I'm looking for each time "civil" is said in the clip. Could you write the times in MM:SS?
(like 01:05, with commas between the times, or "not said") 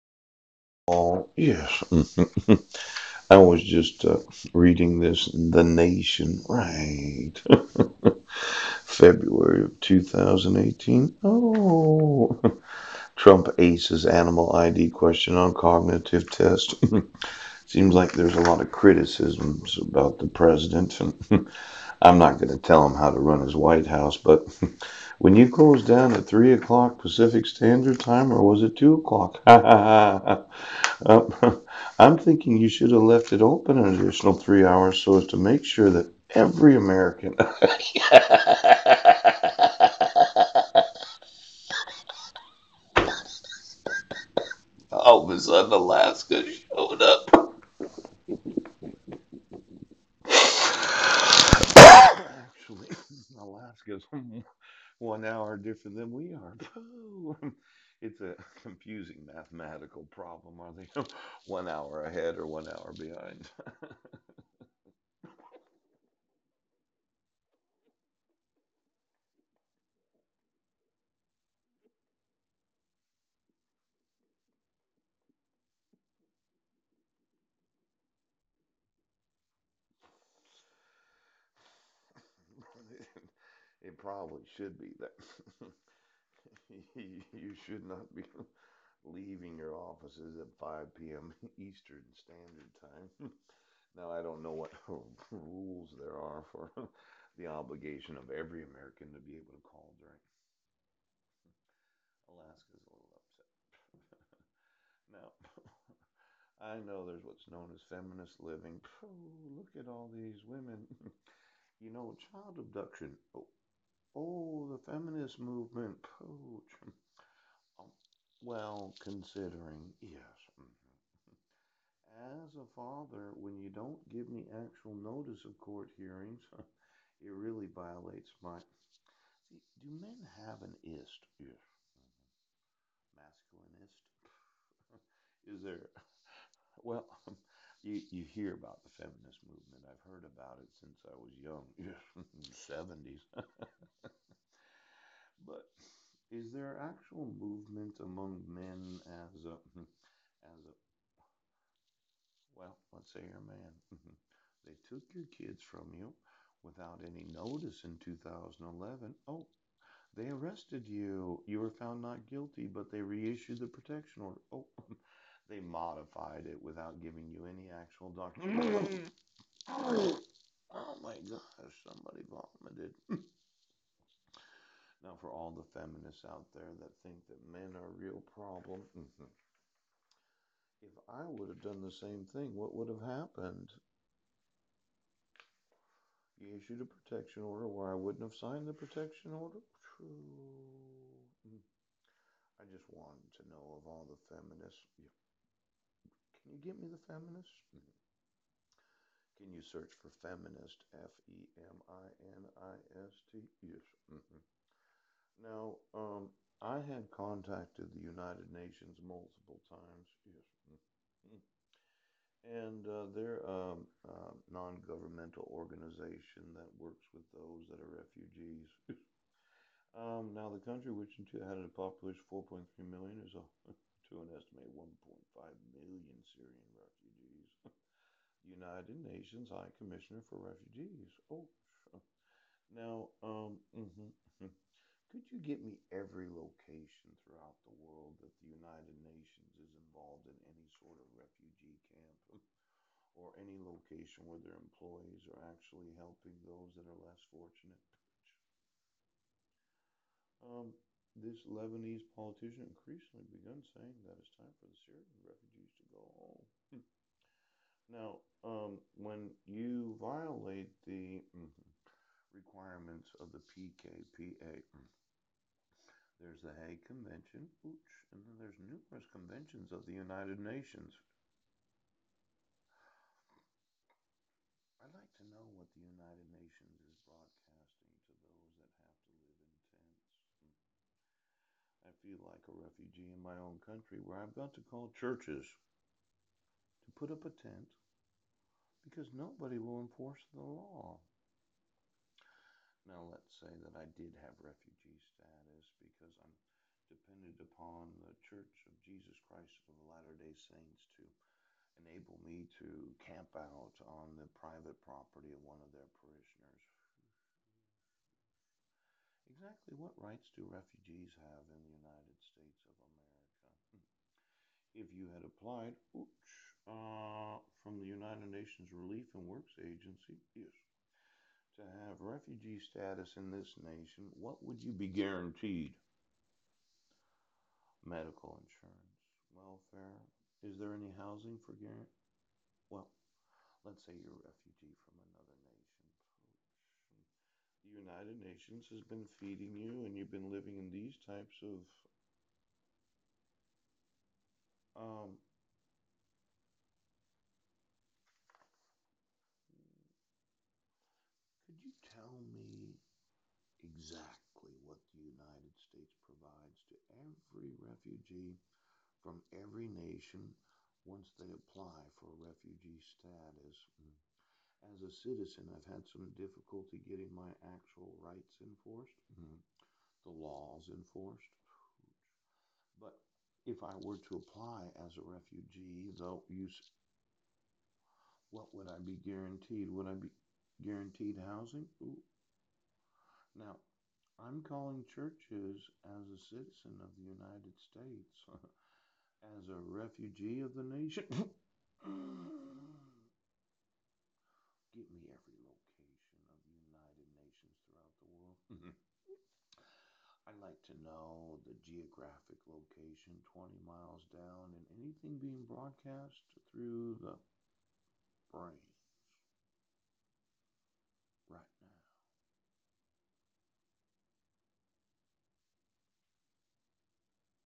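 not said.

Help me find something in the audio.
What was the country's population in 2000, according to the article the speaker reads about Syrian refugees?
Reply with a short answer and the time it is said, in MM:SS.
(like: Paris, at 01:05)
4.3 million, at 03:42.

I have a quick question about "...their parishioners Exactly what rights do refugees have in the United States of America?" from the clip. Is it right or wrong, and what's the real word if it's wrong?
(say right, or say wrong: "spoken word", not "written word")
right.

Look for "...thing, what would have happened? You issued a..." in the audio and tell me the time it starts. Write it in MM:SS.
03:02.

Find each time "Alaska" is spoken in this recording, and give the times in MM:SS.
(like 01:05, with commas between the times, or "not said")
00:45, 00:53, 01:42.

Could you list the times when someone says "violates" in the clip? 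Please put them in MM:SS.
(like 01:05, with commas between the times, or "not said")
02:07, 04:19.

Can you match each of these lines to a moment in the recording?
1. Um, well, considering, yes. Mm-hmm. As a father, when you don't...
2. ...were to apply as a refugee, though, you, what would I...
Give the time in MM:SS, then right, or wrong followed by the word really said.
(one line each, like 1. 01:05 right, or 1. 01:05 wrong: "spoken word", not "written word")
1. 01:57 right
2. 06:13 right.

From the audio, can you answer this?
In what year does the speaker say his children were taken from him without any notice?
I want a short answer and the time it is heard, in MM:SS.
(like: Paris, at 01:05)
2011, at 02:38.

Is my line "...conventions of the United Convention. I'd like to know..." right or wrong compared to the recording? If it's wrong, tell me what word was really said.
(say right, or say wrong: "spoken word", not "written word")
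wrong: "Nations", not "Convention".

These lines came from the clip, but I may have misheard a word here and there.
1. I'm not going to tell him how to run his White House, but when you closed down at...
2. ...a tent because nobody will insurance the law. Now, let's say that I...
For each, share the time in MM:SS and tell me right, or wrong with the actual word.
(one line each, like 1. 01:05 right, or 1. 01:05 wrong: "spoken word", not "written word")
1. 00:22 right
2. 04:47 wrong: "enforce", not "insurance".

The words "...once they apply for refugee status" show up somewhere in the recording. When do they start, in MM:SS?
06:00.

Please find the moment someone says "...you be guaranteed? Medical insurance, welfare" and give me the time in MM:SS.
05:24.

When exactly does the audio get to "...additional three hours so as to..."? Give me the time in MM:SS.
00:33.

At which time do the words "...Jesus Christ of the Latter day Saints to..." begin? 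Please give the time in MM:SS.
04:58.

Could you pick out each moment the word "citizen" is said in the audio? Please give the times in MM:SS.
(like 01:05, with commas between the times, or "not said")
06:05, 06:26.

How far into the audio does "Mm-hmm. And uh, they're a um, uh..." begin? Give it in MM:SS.
03:30.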